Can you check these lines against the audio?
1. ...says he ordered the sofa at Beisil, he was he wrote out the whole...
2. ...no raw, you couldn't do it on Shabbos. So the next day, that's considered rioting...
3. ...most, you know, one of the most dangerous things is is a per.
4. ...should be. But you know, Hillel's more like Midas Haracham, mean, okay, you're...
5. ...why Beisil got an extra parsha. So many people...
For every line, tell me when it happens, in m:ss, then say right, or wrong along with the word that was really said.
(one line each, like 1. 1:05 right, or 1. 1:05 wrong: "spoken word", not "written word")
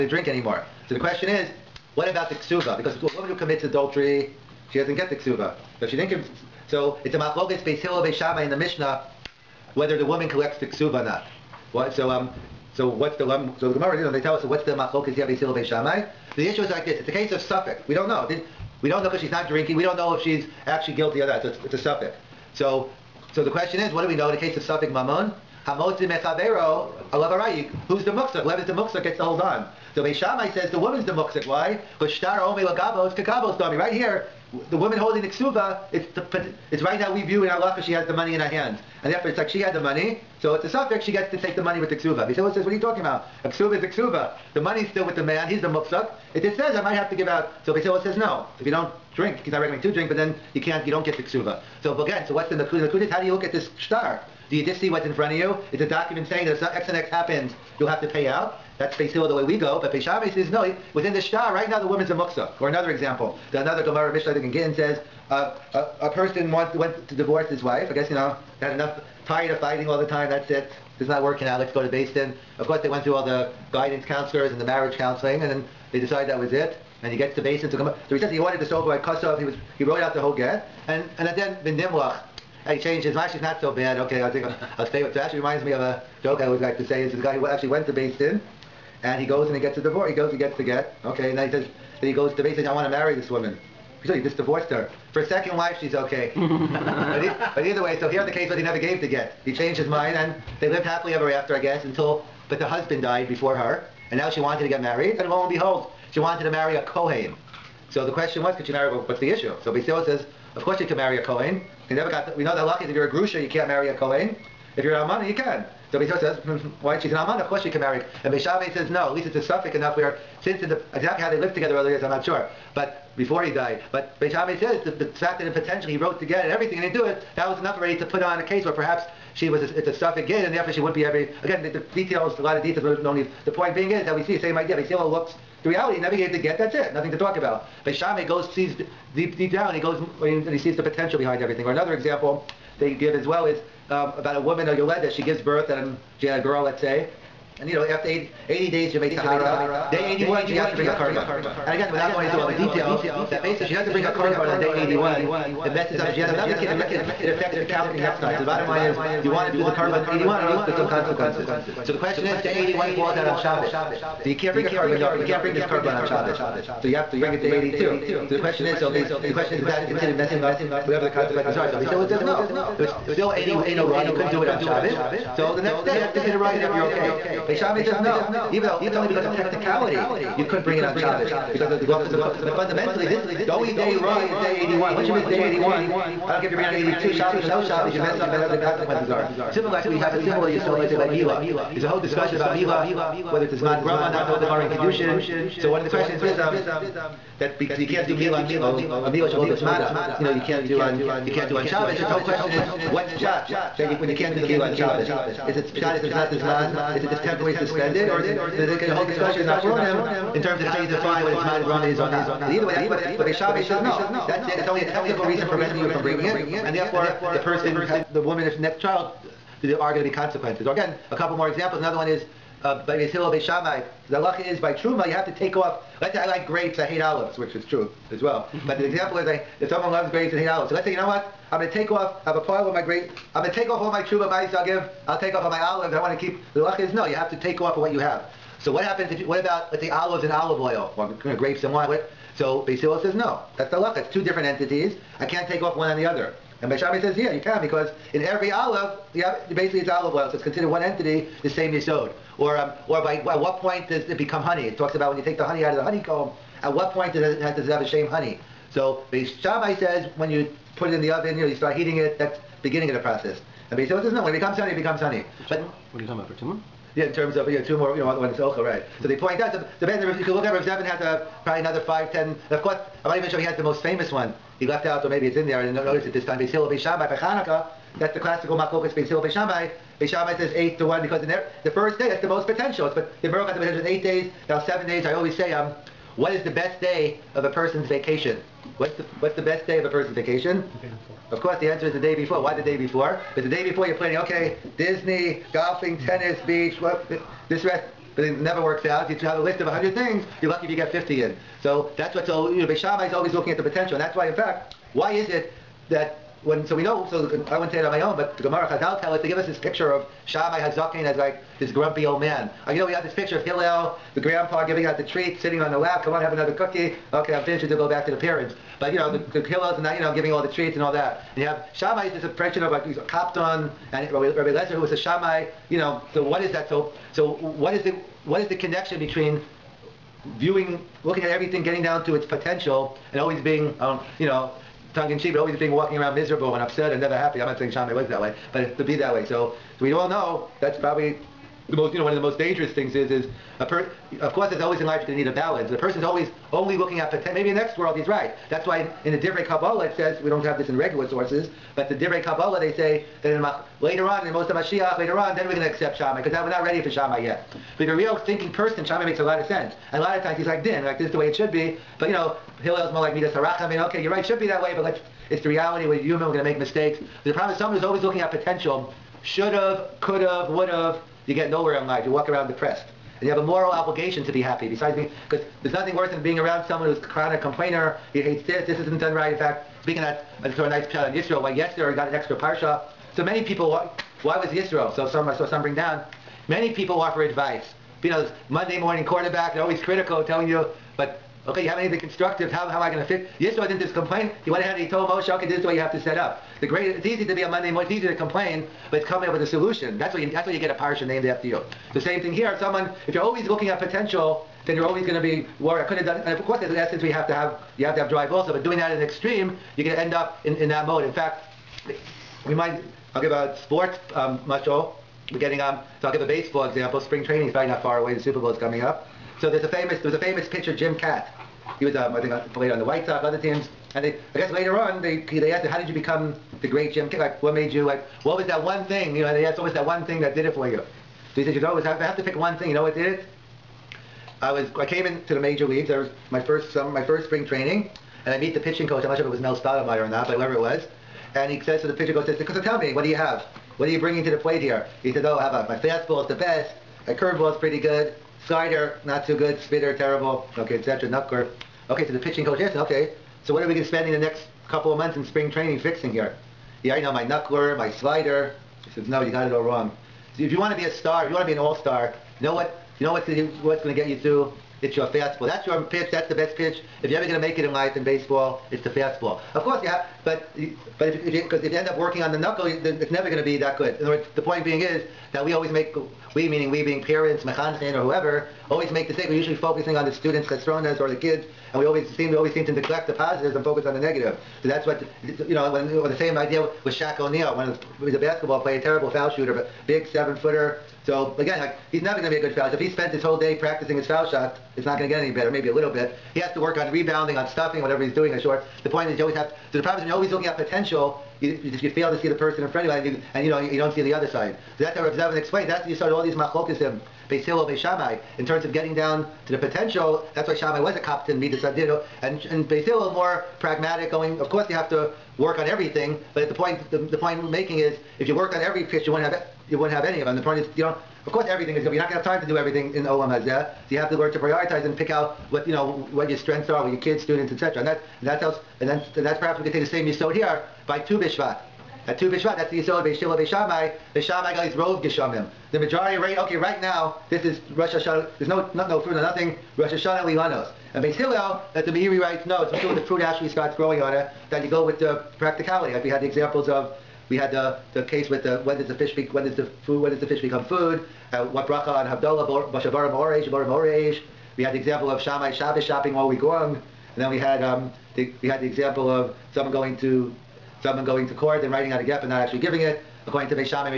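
1. 1:18 wrong: "Kosov", not "Beisil"
2. 2:53 right
3. 5:41 right
4. 6:01 right
5. 6:21 wrong: "Yester", not "Beisil".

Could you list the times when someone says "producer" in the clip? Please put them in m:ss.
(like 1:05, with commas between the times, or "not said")
not said.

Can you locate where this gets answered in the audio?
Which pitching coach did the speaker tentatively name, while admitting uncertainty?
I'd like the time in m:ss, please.
7:19.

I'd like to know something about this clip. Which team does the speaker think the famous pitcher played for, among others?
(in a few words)
White Sox.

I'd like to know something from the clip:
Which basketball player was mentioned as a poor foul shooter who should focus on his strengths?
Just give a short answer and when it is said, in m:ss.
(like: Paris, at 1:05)
Shaq O'Neal, at 8:06.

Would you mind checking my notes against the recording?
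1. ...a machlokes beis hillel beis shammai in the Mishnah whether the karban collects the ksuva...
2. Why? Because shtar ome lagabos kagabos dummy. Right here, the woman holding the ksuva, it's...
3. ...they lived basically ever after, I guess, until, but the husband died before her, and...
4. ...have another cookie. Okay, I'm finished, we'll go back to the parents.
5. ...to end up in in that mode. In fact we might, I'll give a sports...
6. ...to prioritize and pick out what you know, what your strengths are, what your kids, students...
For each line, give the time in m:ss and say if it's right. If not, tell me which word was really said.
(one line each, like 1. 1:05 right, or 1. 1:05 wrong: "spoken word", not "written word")
1. 0:07 wrong: "woman", not "karban"
2. 0:31 right
3. 1:40 wrong: "happily", not "basically"
4. 5:16 right
5. 6:49 right
6. 8:44 right.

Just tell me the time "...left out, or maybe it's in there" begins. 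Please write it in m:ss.
4:34.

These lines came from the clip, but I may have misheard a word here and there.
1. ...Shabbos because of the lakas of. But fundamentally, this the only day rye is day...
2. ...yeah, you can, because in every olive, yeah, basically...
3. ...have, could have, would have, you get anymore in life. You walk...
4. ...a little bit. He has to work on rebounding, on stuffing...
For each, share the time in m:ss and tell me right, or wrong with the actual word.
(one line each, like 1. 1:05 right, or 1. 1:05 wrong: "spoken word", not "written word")
1. 3:00 right
2. 4:07 right
3. 6:09 wrong: "nowhere", not "anymore"
4. 8:15 right.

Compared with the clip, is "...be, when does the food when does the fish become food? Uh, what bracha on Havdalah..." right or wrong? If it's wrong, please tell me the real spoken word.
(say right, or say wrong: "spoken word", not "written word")
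right.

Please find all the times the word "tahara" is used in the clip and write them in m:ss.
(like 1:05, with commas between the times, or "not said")
2:29.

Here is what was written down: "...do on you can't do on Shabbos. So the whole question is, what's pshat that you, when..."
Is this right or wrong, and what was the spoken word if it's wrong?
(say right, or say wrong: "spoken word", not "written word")
right.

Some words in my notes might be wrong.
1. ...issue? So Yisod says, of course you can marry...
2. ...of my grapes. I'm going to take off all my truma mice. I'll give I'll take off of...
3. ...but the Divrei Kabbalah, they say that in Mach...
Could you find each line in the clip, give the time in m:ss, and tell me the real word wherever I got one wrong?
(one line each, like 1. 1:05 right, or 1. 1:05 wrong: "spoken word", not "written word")
1. 1:49 wrong: "Basil", not "Yisod"
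2. 3:52 right
3. 5:51 right.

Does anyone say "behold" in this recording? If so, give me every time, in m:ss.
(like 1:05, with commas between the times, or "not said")
1:45.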